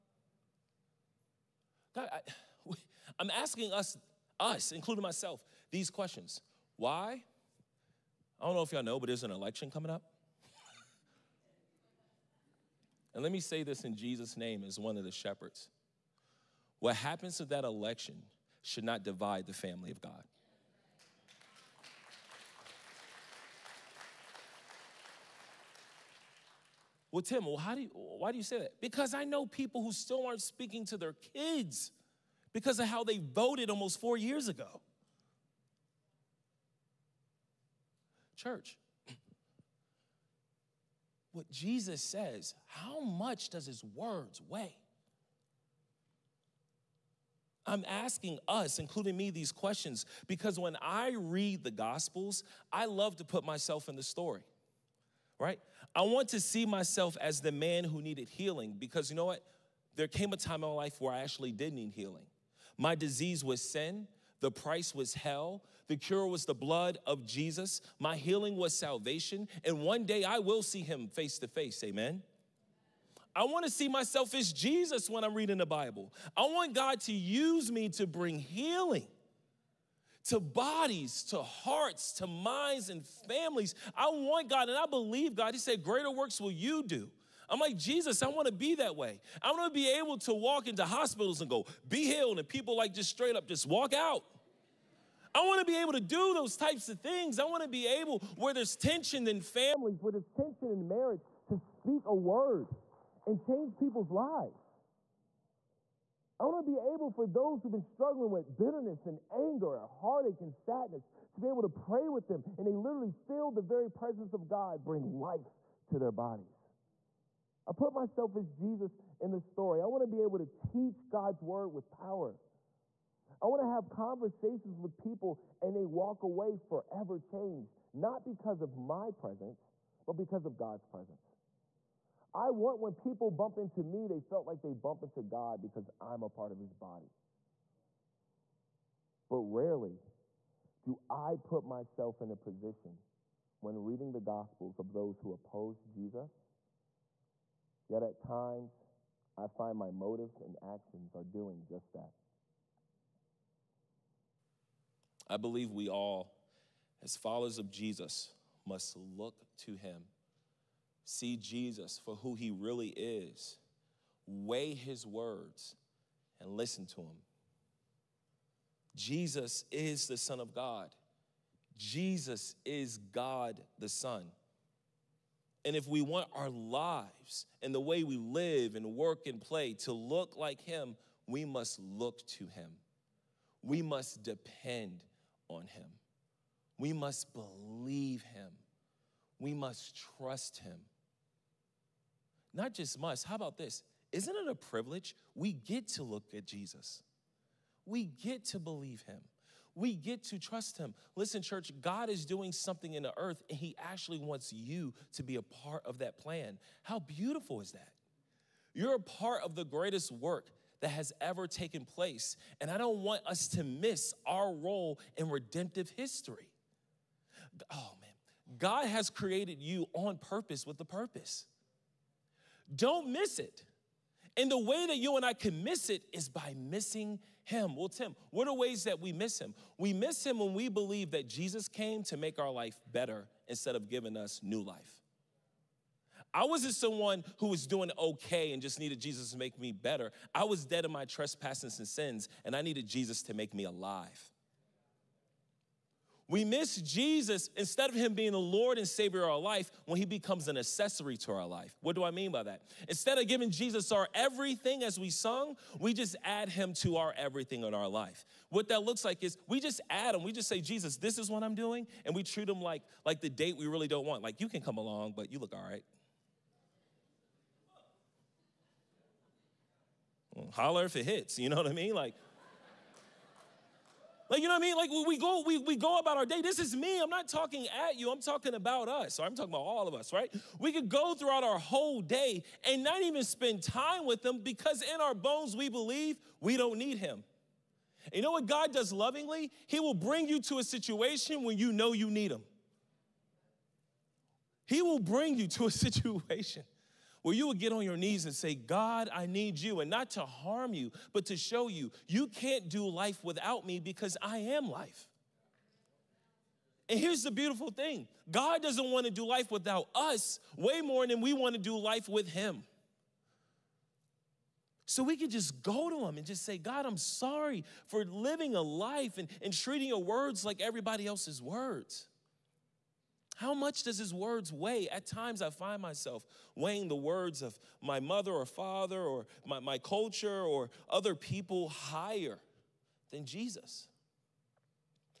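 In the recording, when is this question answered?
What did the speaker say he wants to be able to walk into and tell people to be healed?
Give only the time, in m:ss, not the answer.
1:30.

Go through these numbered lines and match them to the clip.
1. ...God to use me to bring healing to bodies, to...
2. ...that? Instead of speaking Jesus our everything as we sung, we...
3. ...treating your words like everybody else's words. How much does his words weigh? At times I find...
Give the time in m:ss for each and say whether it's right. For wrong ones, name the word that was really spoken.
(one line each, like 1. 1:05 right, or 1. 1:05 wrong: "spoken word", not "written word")
1. 1:16 right
2. 4:12 wrong: "giving", not "speaking"
3. 5:19 right.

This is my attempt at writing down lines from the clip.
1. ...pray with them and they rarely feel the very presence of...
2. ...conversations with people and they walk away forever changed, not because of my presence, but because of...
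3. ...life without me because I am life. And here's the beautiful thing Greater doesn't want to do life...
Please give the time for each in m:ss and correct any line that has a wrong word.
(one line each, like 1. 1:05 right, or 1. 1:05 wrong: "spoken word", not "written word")
1. 1:51 wrong: "literally", not "rarely"
2. 2:03 right
3. 5:02 wrong: "God", not "Greater".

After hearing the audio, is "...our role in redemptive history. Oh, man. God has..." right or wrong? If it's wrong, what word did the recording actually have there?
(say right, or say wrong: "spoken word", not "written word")
right.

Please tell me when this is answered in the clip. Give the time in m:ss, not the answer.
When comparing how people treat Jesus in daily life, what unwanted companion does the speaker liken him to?
4:23.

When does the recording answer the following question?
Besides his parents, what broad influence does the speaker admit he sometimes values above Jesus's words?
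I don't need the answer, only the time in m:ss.
5:29.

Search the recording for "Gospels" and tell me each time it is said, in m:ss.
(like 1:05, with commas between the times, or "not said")
0:51, 2:24.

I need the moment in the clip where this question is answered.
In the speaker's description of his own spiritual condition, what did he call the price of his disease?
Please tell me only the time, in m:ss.
1:04.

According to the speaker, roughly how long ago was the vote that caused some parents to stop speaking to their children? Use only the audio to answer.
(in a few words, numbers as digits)
almost 4 years ago.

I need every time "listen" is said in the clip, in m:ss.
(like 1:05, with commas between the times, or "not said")
2:46, 3:21.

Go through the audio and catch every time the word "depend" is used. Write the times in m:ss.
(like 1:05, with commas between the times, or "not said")
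3:04.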